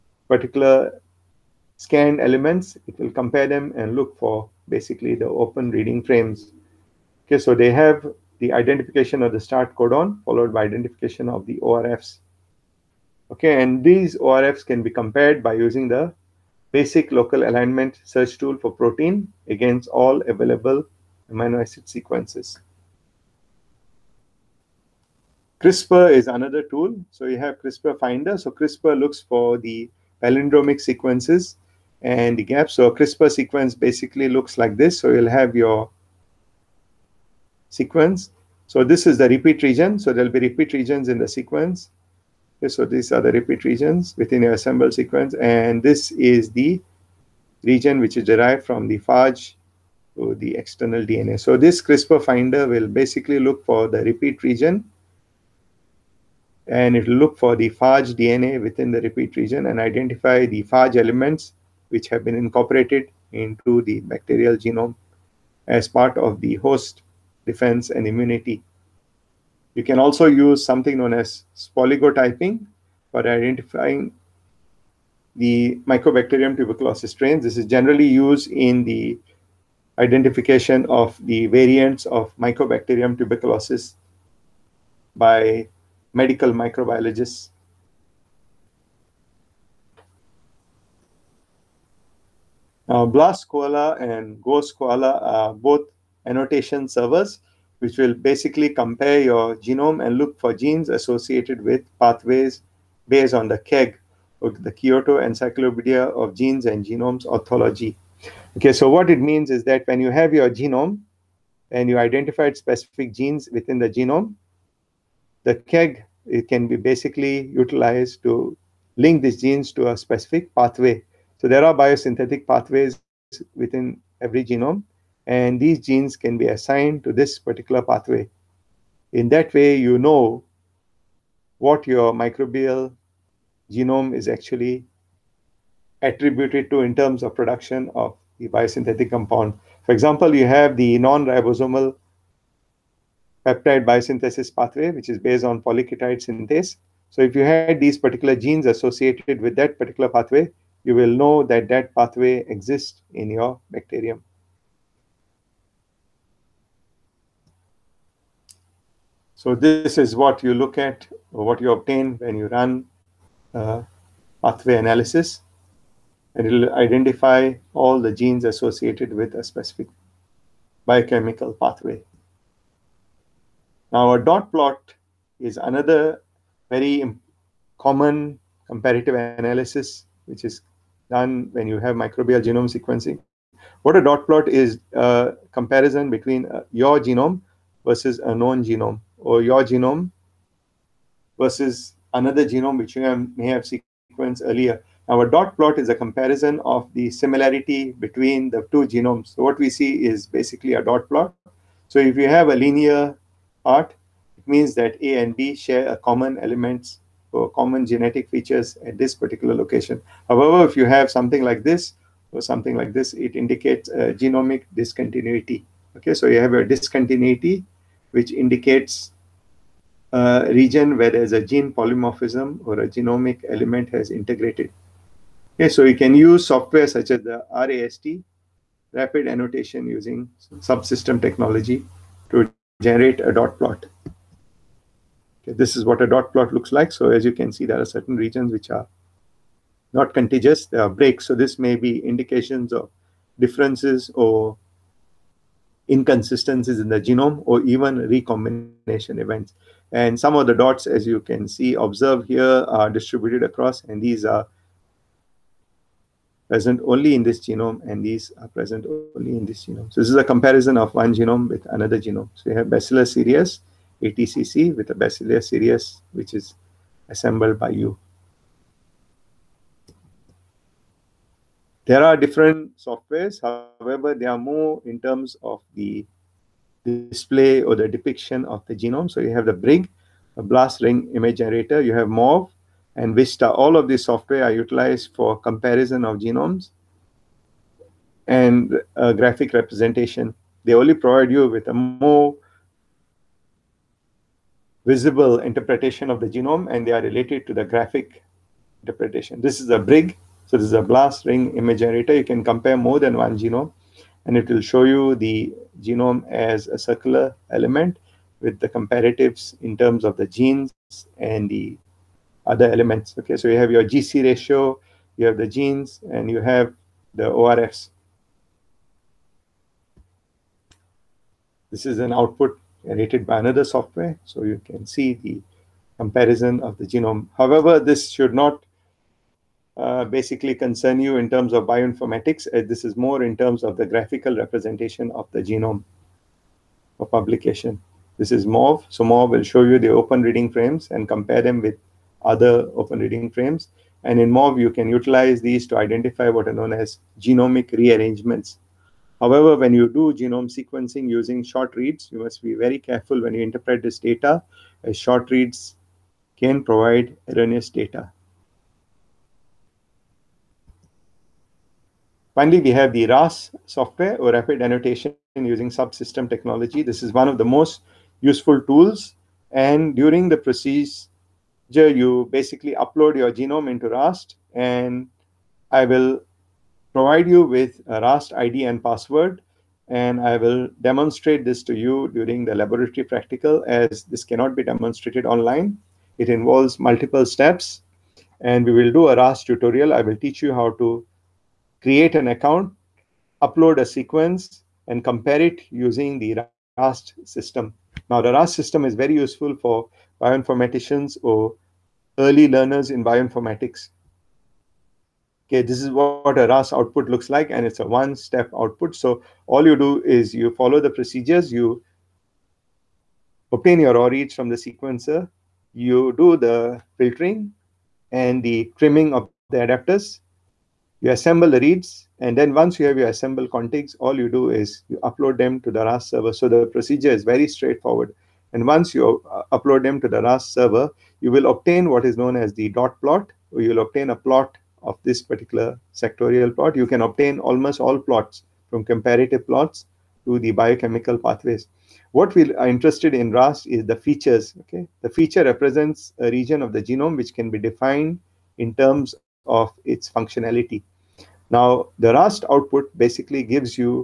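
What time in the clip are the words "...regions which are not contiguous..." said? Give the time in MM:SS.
03:58.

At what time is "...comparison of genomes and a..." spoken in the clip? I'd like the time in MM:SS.
04:45.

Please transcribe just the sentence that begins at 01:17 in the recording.
This is generally used in the identification of the variants of Mycobacterium tuberculosis by medical microbiologists.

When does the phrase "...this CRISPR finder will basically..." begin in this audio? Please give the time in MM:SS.
00:51.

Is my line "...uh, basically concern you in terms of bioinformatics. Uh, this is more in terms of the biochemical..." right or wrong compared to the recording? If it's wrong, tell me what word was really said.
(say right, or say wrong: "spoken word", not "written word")
wrong: "graphical", not "biochemical".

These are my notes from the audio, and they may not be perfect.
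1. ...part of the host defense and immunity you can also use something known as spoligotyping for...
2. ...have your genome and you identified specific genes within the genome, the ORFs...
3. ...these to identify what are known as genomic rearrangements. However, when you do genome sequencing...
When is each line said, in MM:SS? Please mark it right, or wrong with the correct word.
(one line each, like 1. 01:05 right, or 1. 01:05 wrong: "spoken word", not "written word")
1. 01:05 right
2. 01:50 wrong: "KEGG", not "ORFs"
3. 05:45 right.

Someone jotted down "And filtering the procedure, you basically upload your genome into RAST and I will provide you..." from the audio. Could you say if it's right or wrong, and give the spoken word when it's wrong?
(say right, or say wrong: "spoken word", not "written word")
wrong: "during", not "filtering".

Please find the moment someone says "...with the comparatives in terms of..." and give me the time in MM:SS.
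05:08.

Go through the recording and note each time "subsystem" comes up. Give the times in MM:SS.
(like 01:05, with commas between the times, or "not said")
03:50, 06:05.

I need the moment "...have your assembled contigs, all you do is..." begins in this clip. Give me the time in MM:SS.
07:02.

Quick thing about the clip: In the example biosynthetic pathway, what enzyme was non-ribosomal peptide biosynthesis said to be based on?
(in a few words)
Polyketide synthase.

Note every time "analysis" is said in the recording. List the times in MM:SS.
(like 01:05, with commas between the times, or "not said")
02:44, 02:59.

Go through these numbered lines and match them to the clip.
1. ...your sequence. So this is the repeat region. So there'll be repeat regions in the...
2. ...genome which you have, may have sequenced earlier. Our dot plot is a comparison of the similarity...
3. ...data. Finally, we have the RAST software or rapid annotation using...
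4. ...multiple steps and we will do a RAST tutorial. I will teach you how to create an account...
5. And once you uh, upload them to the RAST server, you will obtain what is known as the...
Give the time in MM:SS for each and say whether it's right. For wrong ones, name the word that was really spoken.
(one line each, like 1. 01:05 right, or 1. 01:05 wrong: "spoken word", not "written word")
1. 00:35 right
2. 03:12 right
3. 05:57 right
4. 06:26 right
5. 07:08 right.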